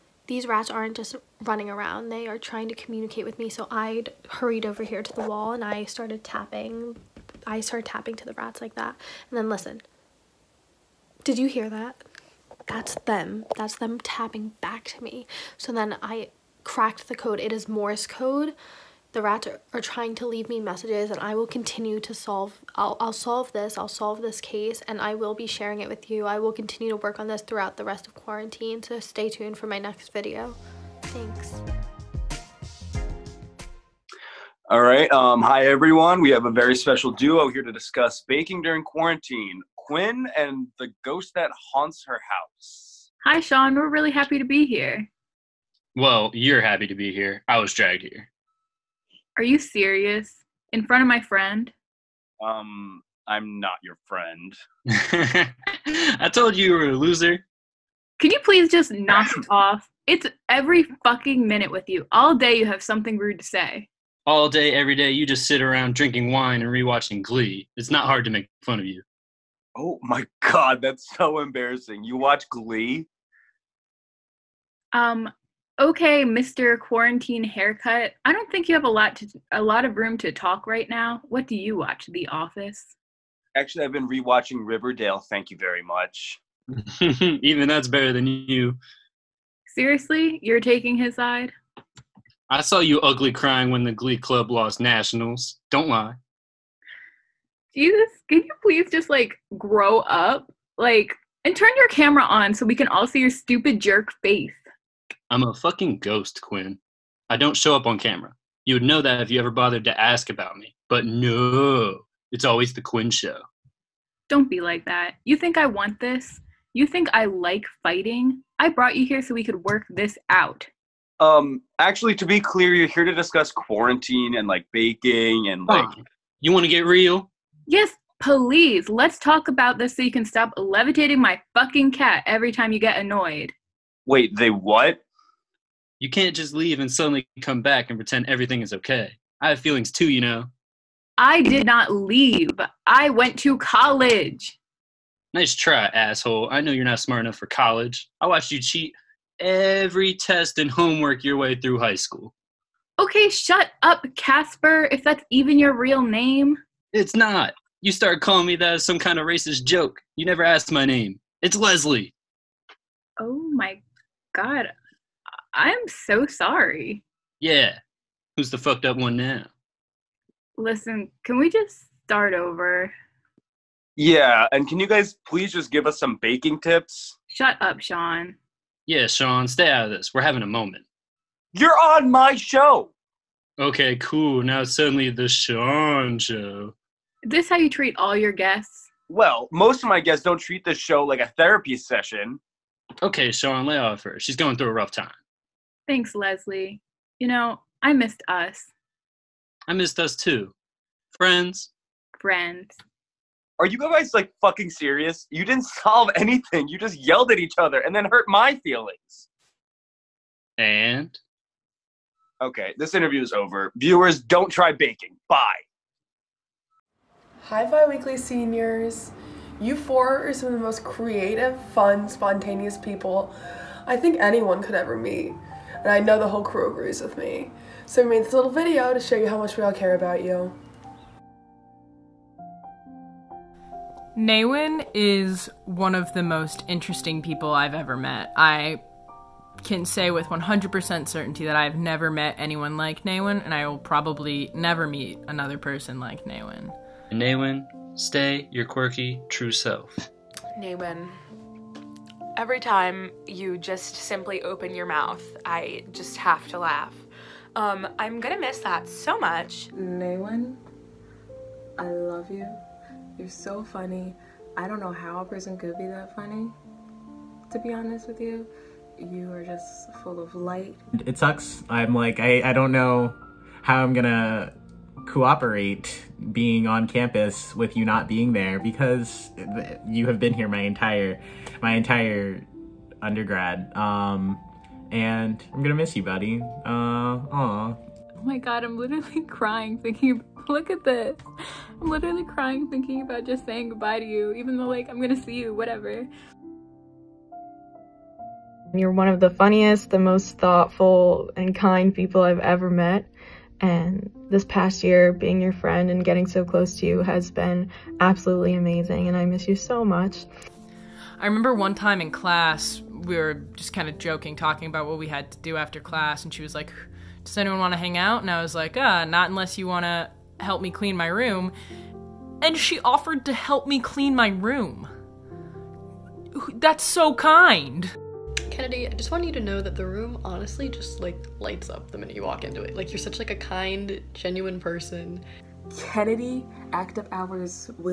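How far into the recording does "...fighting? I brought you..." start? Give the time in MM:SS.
01:57.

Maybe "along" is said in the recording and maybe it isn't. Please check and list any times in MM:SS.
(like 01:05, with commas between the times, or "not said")
not said.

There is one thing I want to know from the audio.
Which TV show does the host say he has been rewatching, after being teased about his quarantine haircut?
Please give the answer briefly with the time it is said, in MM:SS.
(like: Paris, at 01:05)
Riverdale, at 01:24.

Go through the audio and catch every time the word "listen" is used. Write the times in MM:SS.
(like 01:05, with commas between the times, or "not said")
00:09, 02:50.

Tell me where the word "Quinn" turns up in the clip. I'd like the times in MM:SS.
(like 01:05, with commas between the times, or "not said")
00:39, 01:46, 01:52.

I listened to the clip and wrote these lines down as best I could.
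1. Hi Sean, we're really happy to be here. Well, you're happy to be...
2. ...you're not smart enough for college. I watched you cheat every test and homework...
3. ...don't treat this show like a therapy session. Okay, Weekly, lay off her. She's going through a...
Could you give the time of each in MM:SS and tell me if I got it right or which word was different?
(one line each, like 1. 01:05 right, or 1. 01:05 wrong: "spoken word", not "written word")
1. 00:43 right
2. 02:26 right
3. 03:10 wrong: "Sean", not "Weekly".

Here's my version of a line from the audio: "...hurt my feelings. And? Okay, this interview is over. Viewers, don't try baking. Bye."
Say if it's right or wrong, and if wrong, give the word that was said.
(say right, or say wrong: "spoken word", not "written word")
right.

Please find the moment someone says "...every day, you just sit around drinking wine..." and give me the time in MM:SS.
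01:04.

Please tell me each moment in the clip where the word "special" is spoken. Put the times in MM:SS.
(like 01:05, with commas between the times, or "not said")
00:36.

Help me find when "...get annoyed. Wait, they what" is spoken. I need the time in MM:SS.
02:12.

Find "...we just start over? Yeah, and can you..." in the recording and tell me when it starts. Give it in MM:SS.
02:51.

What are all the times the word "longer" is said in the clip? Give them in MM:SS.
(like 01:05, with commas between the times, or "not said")
not said.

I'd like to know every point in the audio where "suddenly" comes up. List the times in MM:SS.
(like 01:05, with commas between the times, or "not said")
02:16, 03:04.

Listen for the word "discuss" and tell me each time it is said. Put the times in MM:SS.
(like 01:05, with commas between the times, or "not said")
00:37, 02:03.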